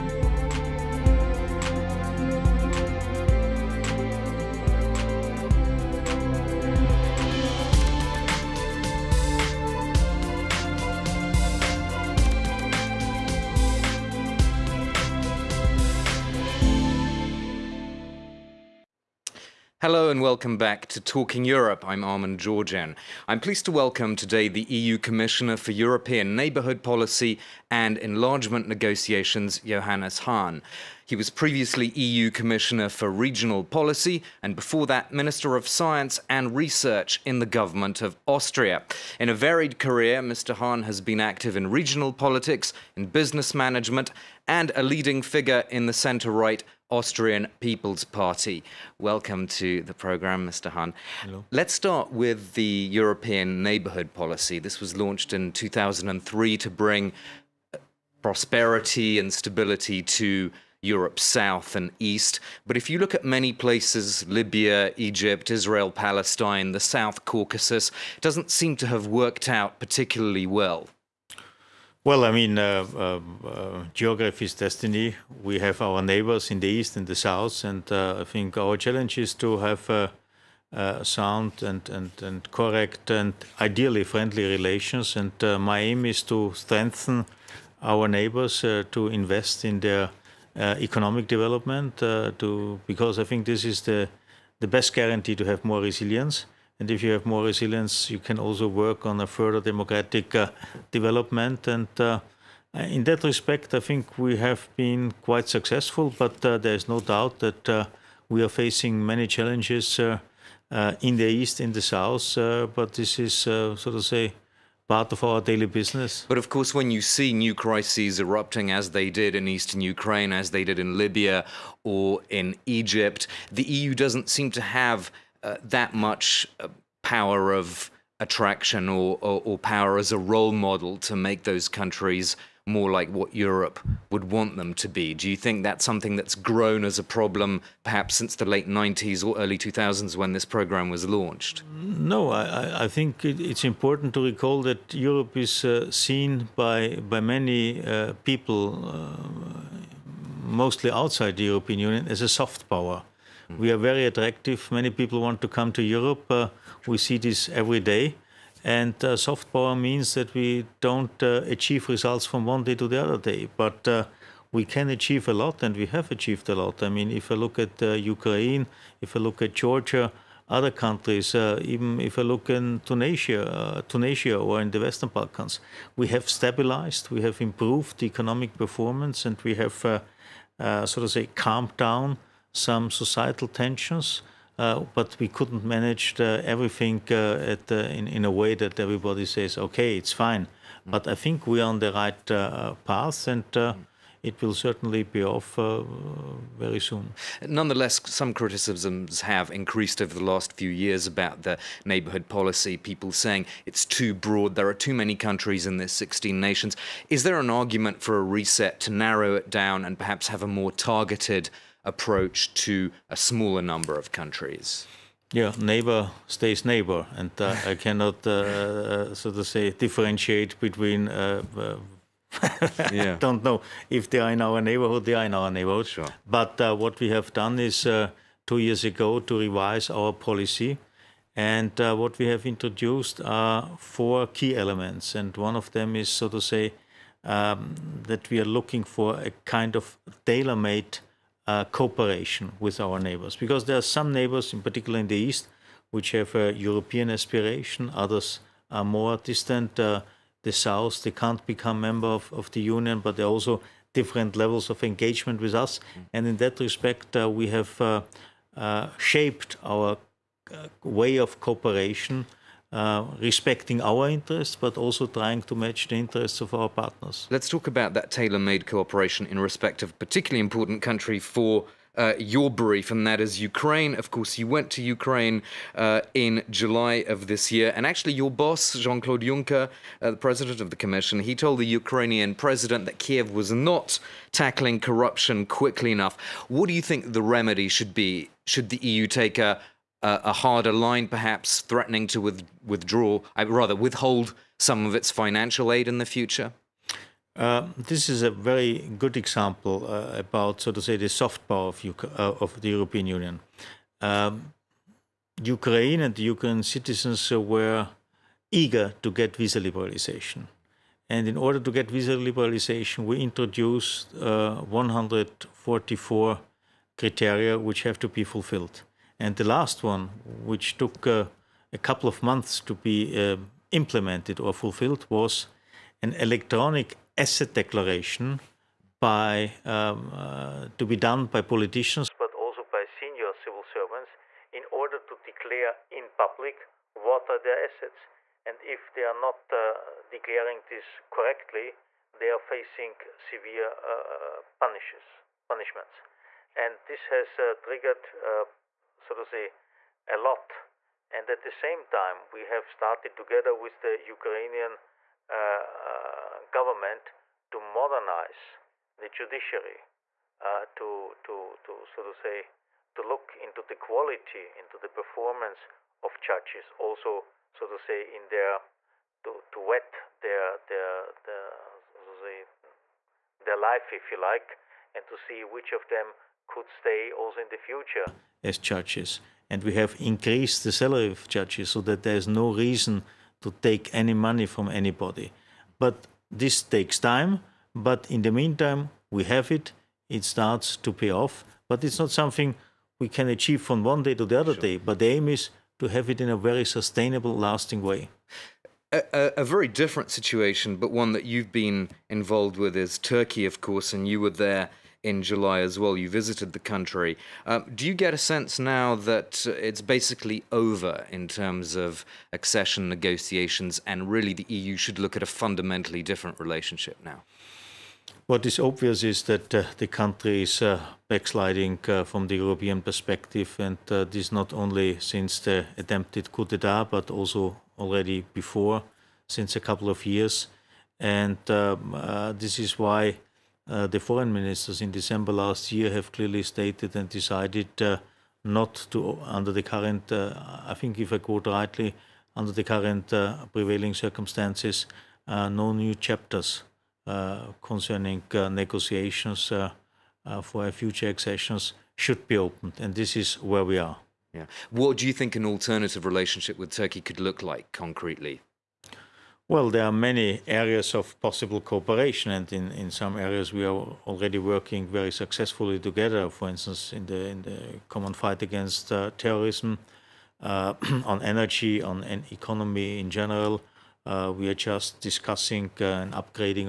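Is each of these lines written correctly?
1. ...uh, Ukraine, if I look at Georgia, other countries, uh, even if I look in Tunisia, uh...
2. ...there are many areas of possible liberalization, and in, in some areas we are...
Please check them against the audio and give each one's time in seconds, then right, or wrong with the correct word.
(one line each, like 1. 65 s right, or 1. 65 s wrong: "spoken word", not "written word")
1. 167 s right
2. 459 s wrong: "cooperation", not "liberalization".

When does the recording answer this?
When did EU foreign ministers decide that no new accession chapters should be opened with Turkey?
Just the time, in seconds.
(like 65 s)
434 s.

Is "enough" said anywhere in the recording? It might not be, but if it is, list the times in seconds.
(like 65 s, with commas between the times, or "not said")
285 s.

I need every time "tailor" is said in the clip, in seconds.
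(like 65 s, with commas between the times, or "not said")
240 s, 268 s.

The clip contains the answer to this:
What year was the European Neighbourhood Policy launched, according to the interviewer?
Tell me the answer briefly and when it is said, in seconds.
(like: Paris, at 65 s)
2003, at 55 s.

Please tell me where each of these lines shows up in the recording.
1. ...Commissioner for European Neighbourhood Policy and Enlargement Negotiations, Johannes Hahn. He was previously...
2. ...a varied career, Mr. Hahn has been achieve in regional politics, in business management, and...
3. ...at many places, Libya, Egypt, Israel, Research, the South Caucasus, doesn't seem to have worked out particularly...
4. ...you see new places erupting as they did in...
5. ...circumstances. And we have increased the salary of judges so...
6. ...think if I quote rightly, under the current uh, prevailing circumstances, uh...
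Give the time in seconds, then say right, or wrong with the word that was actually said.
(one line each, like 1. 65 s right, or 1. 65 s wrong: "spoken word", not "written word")
1. 24 s right
2. 39 s wrong: "active", not "achieve"
3. 63 s wrong: "Palestine", not "Research"
4. 116 s wrong: "crises", not "places"
5. 378 s wrong: "judges", not "circumstances"
6. 440 s right.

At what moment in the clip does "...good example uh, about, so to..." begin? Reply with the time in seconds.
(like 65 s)
298 s.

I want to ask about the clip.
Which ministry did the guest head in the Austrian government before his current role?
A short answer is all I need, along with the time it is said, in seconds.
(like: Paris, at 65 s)
Science and Research, at 35 s.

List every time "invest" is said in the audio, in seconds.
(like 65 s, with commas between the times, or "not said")
89 s.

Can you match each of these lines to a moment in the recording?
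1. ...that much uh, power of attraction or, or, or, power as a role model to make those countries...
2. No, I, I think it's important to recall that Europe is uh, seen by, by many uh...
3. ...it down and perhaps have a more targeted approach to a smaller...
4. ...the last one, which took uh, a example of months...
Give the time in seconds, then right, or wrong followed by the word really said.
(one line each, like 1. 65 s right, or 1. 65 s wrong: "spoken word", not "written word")
1. 125 s right
2. 141 s right
3. 209 s right
4. 319 s wrong: "couple", not "example".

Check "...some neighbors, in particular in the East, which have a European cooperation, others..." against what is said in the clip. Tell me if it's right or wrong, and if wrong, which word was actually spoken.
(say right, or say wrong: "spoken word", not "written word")
wrong: "aspiration", not "cooperation".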